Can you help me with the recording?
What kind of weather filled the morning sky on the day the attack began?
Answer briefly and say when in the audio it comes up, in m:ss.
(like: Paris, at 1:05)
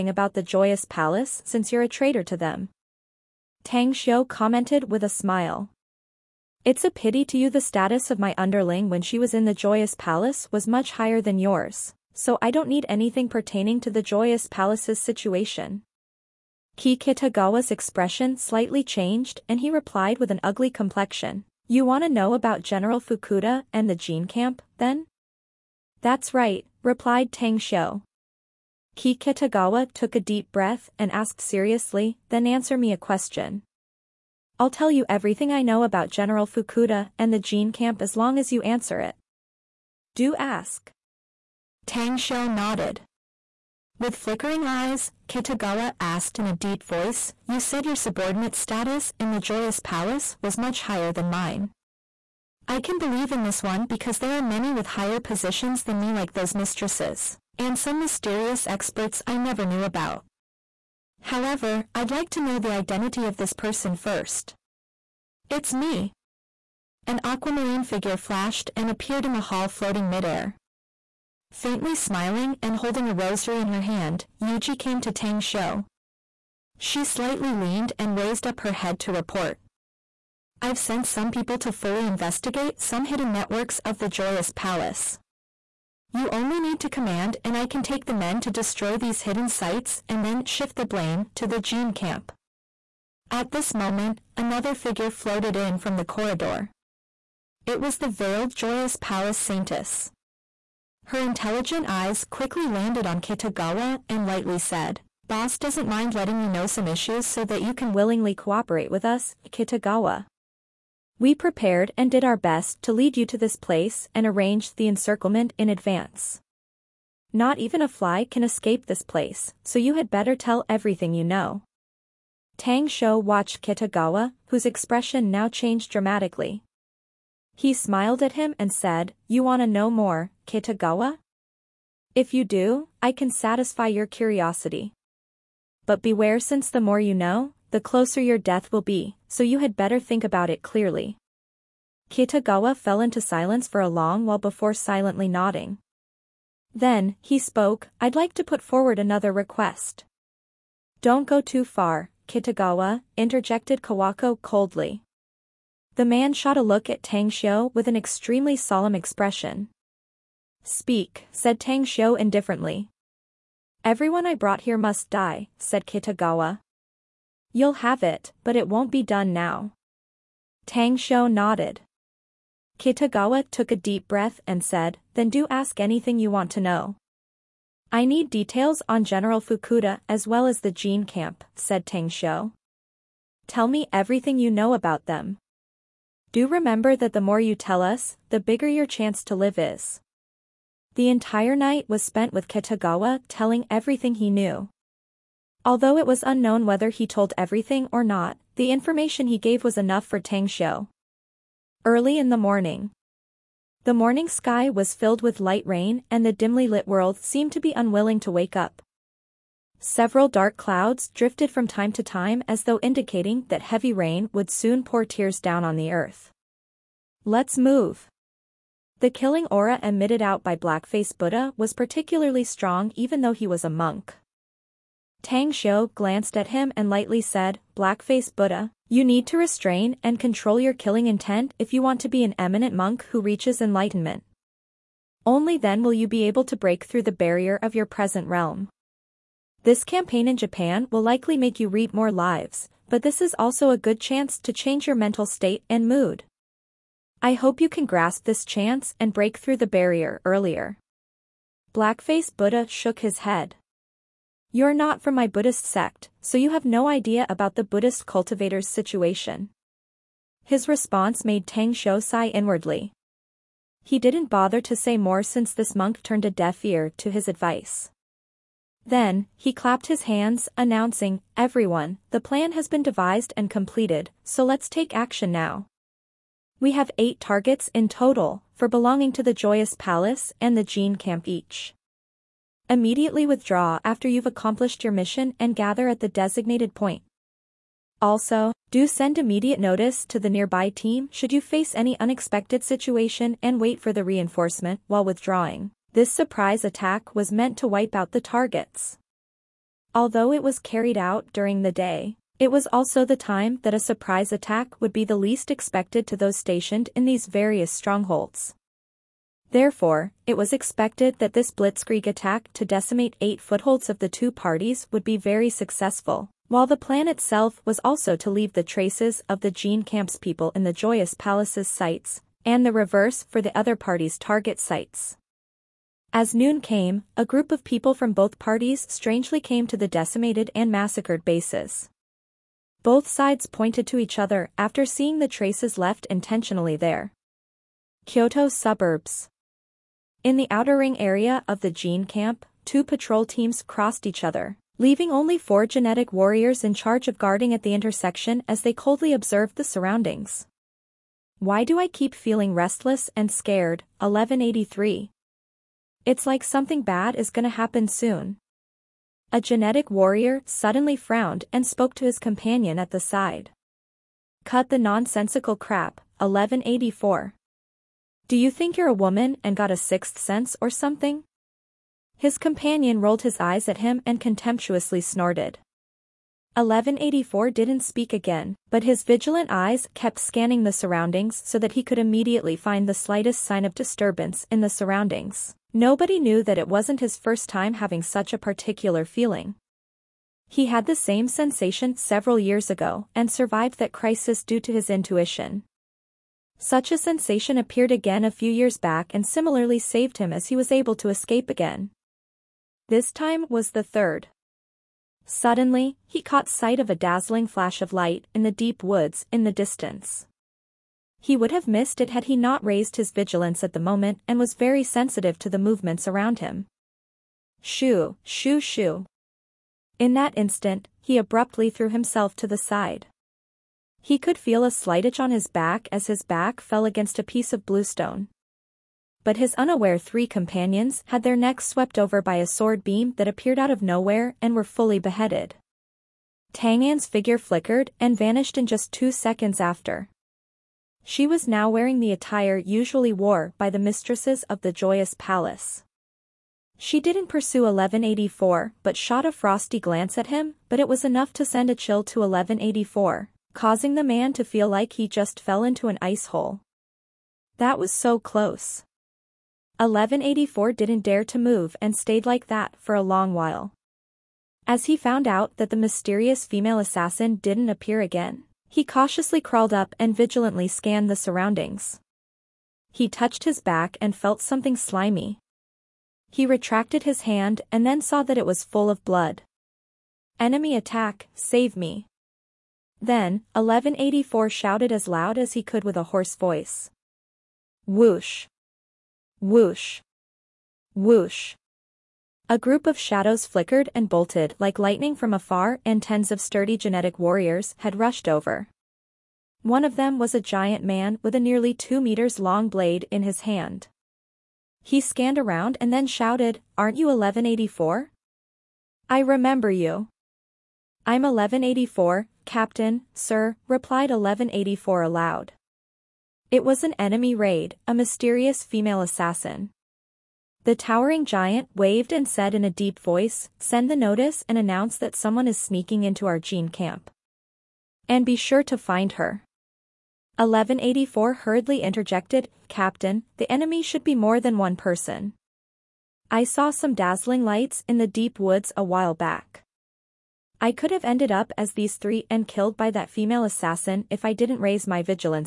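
Light rain, at 3:25.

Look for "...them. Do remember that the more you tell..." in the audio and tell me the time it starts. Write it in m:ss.
3:05.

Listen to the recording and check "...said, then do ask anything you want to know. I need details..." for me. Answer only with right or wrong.
right.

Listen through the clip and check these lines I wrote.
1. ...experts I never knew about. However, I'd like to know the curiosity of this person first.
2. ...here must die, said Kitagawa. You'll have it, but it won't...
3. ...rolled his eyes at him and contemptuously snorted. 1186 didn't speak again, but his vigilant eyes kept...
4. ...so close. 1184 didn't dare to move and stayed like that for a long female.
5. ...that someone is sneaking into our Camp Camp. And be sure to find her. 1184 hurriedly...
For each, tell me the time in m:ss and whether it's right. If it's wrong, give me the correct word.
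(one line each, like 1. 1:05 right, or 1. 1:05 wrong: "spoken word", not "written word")
1. 0:58 wrong: "identity", not "curiosity"
2. 2:44 right
3. 6:13 wrong: "1184", not "1186"
4. 7:37 wrong: "while", not "female"
5. 8:44 wrong: "Gene", not "Camp".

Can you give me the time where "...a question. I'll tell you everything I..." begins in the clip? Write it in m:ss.
0:32.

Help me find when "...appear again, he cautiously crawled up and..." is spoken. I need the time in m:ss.
7:47.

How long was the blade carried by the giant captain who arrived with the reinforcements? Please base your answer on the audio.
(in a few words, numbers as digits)
Nearly two meters.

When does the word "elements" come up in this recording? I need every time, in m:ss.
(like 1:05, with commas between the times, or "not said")
not said.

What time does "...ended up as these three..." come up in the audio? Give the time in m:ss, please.
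9:01.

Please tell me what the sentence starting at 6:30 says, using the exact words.
He had the same sensation several years ago and survived that crisis due to his intuition.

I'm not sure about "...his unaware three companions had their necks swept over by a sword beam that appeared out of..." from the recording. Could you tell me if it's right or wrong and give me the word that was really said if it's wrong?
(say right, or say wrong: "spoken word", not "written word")
right.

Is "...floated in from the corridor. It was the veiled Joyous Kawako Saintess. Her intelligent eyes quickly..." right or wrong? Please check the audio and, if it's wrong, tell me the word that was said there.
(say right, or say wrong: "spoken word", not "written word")
wrong: "Palace", not "Kawako".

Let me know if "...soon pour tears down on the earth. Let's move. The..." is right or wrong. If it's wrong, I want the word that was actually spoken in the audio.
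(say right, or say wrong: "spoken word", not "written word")
right.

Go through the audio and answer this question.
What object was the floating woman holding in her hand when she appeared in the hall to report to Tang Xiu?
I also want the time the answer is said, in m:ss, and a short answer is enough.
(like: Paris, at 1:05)
A rosary, at 1:13.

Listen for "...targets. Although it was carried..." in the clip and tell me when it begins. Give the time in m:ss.
4:58.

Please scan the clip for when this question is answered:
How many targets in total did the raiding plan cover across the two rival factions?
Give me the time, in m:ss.
4:36.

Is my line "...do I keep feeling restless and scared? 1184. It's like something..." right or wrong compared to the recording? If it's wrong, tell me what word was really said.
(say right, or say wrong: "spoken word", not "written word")
wrong: "1183", not "1184".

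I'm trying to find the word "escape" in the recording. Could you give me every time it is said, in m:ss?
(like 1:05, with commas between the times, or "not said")
1:58, 6:41.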